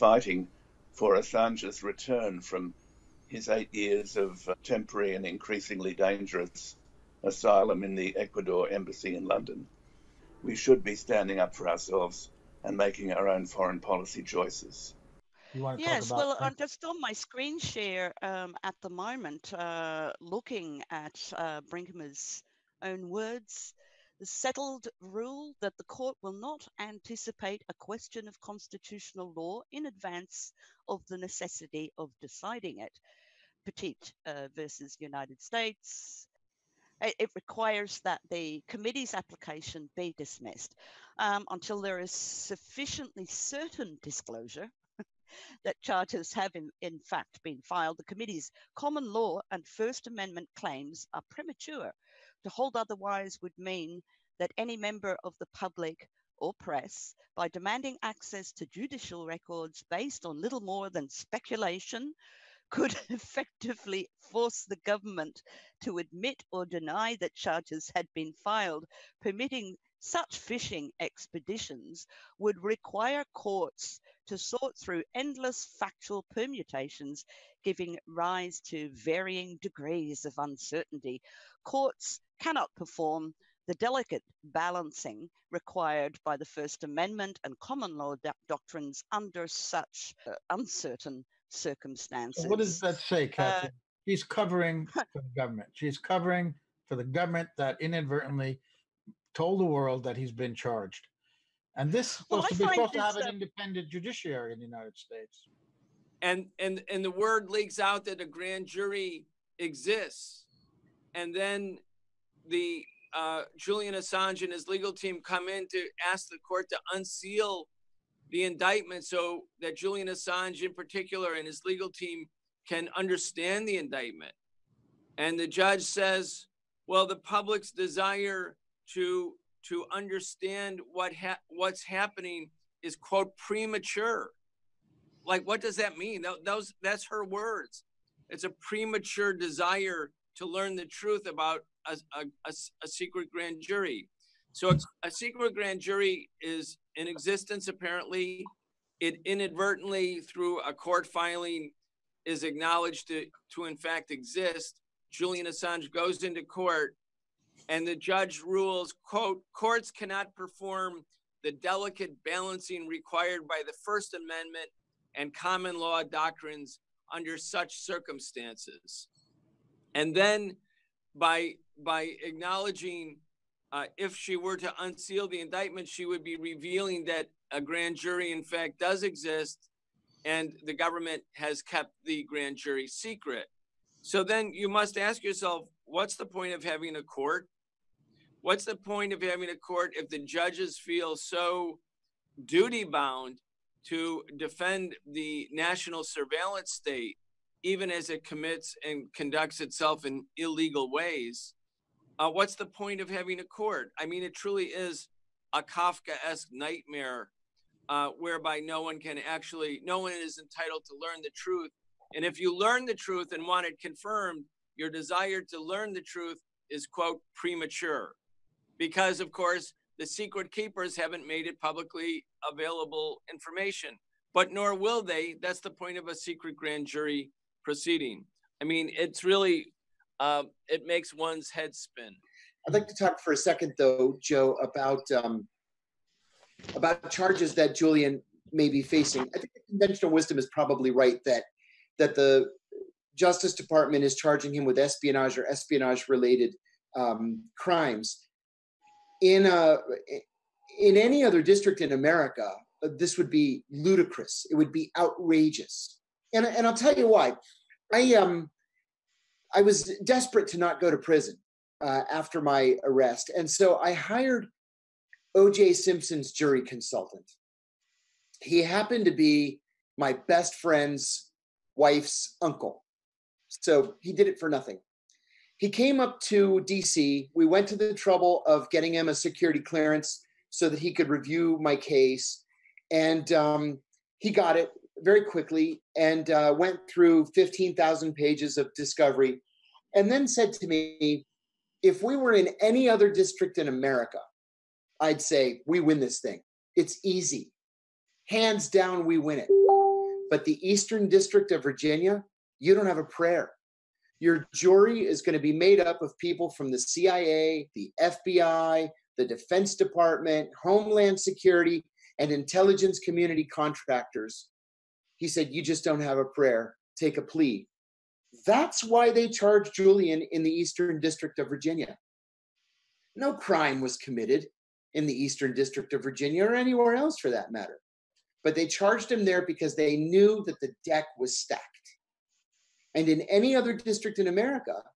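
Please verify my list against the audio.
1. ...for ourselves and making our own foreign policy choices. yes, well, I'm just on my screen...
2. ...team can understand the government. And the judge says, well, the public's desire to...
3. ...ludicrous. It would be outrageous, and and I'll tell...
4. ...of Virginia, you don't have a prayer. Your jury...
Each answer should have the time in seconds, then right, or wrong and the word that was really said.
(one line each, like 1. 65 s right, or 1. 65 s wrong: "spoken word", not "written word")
1. 11 s right
2. 121 s wrong: "indictment", not "government"
3. 253 s right
4. 301 s right.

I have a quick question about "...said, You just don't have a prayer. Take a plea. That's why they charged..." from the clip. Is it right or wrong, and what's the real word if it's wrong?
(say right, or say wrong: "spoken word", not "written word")
right.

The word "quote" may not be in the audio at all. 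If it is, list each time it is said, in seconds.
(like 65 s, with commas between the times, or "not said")
132 s, 159 s, 216 s.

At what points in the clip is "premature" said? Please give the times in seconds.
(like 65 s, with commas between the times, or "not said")
51 s, 133 s, 138 s, 217 s.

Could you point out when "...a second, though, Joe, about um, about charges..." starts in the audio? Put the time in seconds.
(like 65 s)
233 s.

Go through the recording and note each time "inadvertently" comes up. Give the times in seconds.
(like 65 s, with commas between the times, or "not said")
97 s, 149 s.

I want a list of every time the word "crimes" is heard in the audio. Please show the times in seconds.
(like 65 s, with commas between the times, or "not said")
247 s, 323 s.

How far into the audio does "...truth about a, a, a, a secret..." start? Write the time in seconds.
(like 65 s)
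140 s.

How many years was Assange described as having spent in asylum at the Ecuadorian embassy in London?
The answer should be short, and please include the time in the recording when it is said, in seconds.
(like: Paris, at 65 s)
8, at 3 s.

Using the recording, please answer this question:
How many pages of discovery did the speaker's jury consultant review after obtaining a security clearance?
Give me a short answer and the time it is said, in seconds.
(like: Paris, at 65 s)
15,000, at 287 s.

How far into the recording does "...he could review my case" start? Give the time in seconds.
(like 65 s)
280 s.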